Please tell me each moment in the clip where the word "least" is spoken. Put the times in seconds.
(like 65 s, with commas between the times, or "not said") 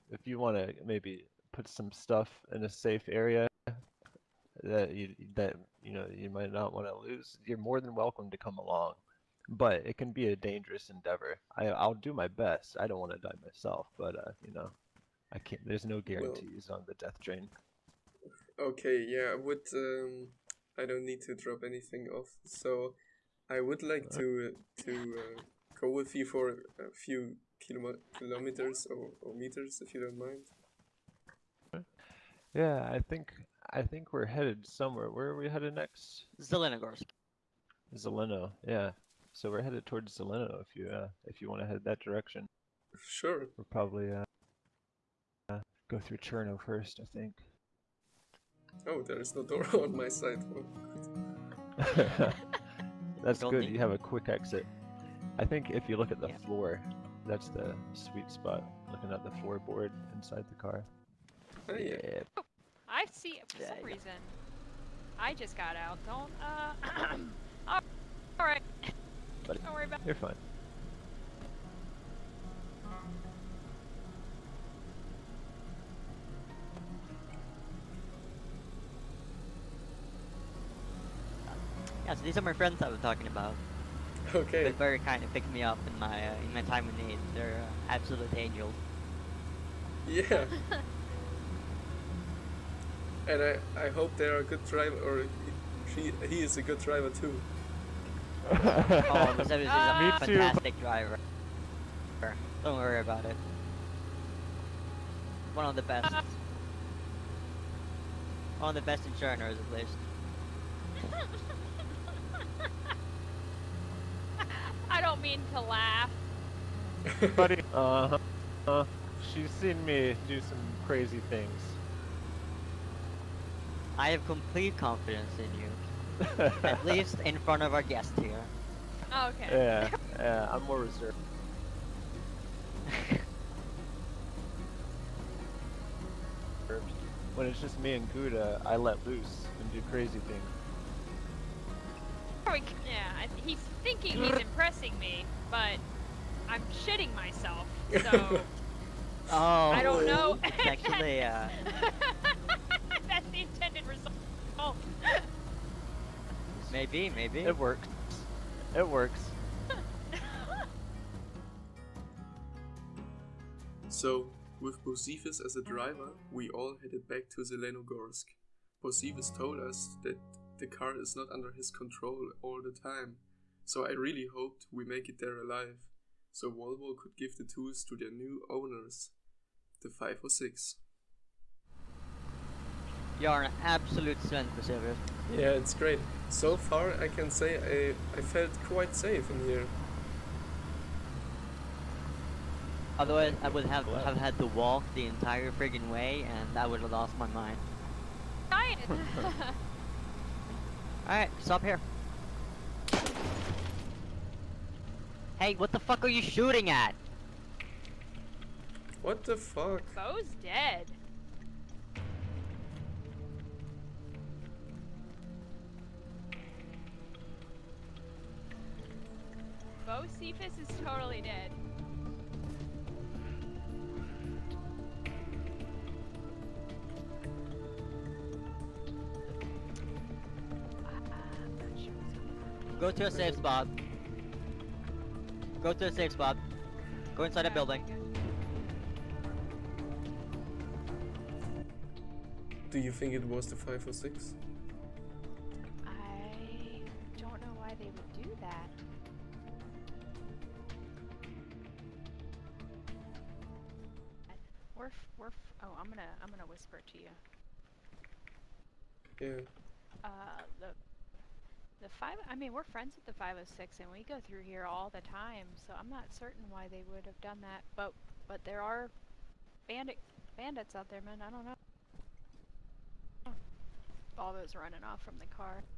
109 s, 126 s.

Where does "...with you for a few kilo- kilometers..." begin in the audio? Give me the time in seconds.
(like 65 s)
25 s.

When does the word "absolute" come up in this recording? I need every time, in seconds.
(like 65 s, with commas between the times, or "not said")
87 s, 183 s.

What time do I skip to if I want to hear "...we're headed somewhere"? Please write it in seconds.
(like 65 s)
34 s.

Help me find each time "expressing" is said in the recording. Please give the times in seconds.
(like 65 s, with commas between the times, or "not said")
not said.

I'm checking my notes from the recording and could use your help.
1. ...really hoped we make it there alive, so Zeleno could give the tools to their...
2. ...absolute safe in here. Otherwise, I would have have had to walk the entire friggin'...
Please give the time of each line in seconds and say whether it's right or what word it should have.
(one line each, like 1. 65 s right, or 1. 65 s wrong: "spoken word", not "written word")
1. 173 s wrong: "Volvo", not "Zeleno"
2. 188 s wrong: "quite", not "absolute".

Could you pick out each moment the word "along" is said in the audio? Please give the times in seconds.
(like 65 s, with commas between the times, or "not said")
8 s.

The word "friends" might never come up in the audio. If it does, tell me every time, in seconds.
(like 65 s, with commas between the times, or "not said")
82 s, 262 s.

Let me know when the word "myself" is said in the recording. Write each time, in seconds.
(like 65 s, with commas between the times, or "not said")
13 s, 147 s.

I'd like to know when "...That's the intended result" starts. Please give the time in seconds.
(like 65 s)
153 s.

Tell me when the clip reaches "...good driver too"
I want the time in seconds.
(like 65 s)
96 s.